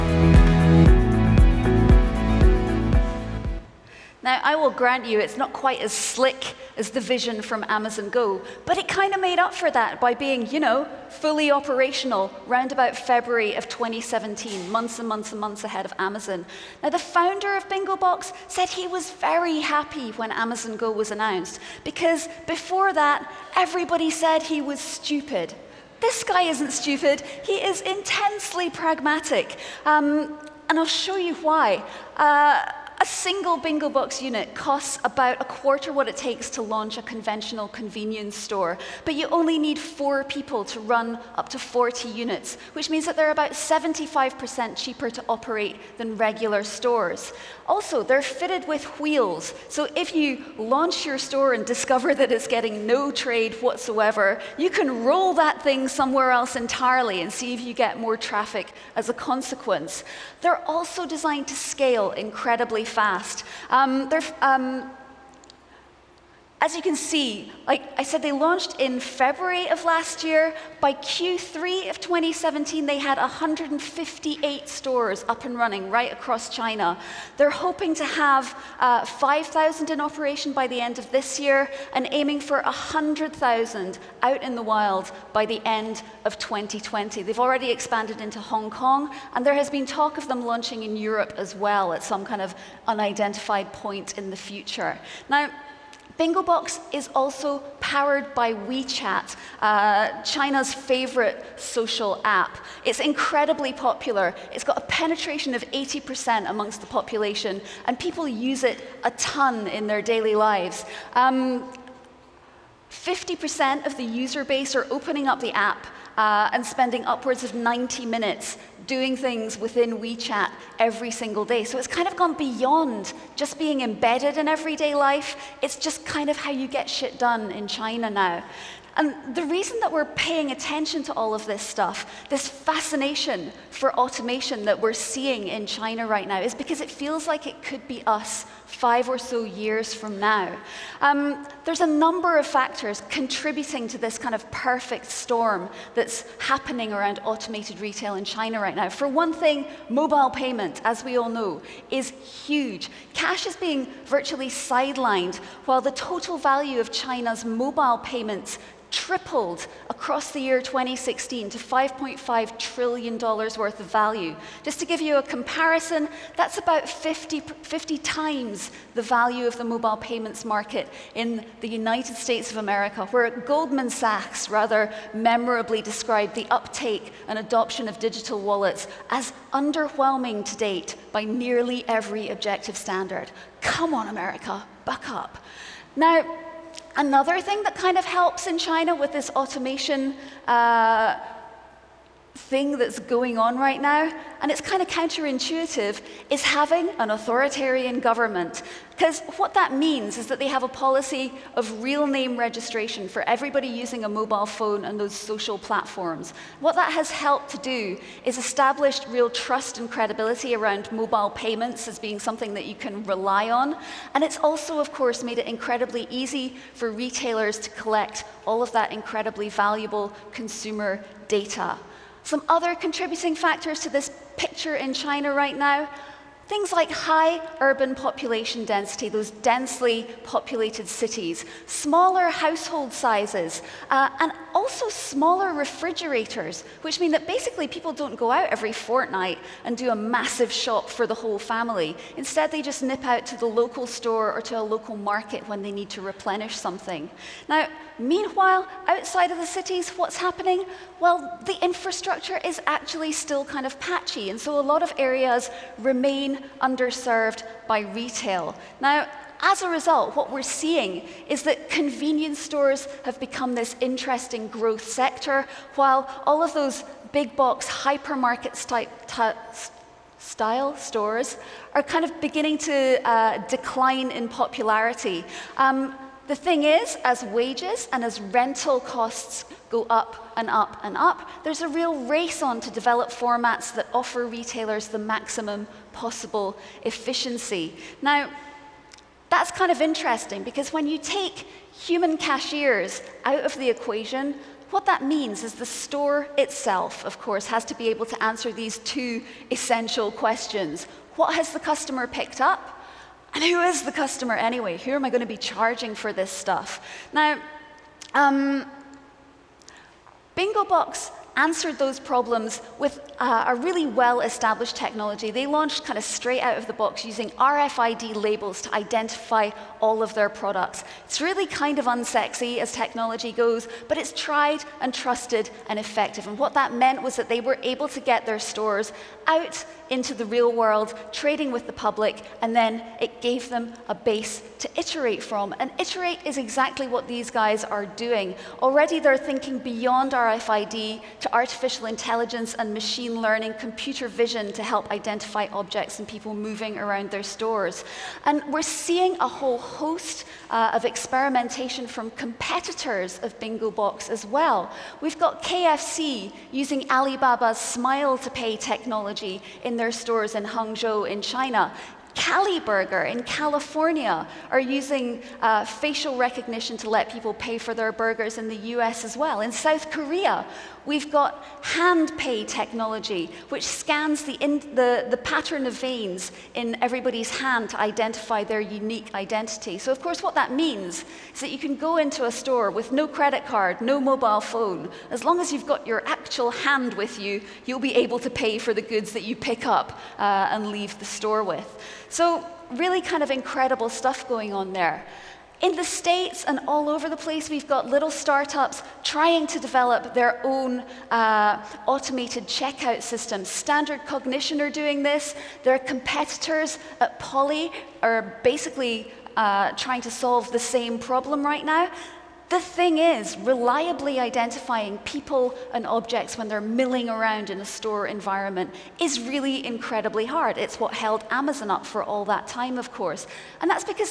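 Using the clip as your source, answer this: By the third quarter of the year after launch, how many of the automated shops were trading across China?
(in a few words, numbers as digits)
158.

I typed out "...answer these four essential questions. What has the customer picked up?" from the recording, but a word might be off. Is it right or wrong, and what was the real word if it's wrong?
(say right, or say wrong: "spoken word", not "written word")
wrong: "two", not "four".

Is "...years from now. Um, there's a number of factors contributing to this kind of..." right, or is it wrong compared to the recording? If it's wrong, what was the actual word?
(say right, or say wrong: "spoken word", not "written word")
right.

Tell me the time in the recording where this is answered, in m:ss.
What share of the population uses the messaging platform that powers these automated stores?
1:45.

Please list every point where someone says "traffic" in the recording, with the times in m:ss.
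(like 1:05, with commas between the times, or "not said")
0:58.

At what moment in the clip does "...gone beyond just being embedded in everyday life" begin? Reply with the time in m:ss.
2:02.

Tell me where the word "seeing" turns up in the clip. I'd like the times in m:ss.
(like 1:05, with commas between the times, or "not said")
2:14, 4:20, 5:48.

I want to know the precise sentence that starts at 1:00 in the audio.
They're also designed to scale incredibly fast.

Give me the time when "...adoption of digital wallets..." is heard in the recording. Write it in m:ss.
2:57.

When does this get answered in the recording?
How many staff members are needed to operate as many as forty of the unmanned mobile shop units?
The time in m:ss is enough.
0:39.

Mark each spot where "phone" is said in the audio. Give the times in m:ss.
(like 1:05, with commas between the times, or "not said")
3:24, 6:24.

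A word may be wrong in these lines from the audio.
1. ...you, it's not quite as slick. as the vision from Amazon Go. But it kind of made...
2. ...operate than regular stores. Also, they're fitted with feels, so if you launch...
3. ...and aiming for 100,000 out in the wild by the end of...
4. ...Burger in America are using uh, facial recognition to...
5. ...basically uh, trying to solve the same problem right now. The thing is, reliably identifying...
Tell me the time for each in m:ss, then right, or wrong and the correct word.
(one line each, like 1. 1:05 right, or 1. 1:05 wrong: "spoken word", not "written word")
1. 0:05 right
2. 0:45 wrong: "wheels", not "feels"
3. 1:21 right
4. 6:02 wrong: "California", not "America"
5. 6:48 right.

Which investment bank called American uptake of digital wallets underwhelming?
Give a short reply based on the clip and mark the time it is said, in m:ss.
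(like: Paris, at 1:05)
Goldman Sachs, at 2:53.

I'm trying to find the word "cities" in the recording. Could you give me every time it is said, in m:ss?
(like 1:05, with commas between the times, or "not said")
3:50, 4:09.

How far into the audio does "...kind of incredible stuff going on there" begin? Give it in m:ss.
6:33.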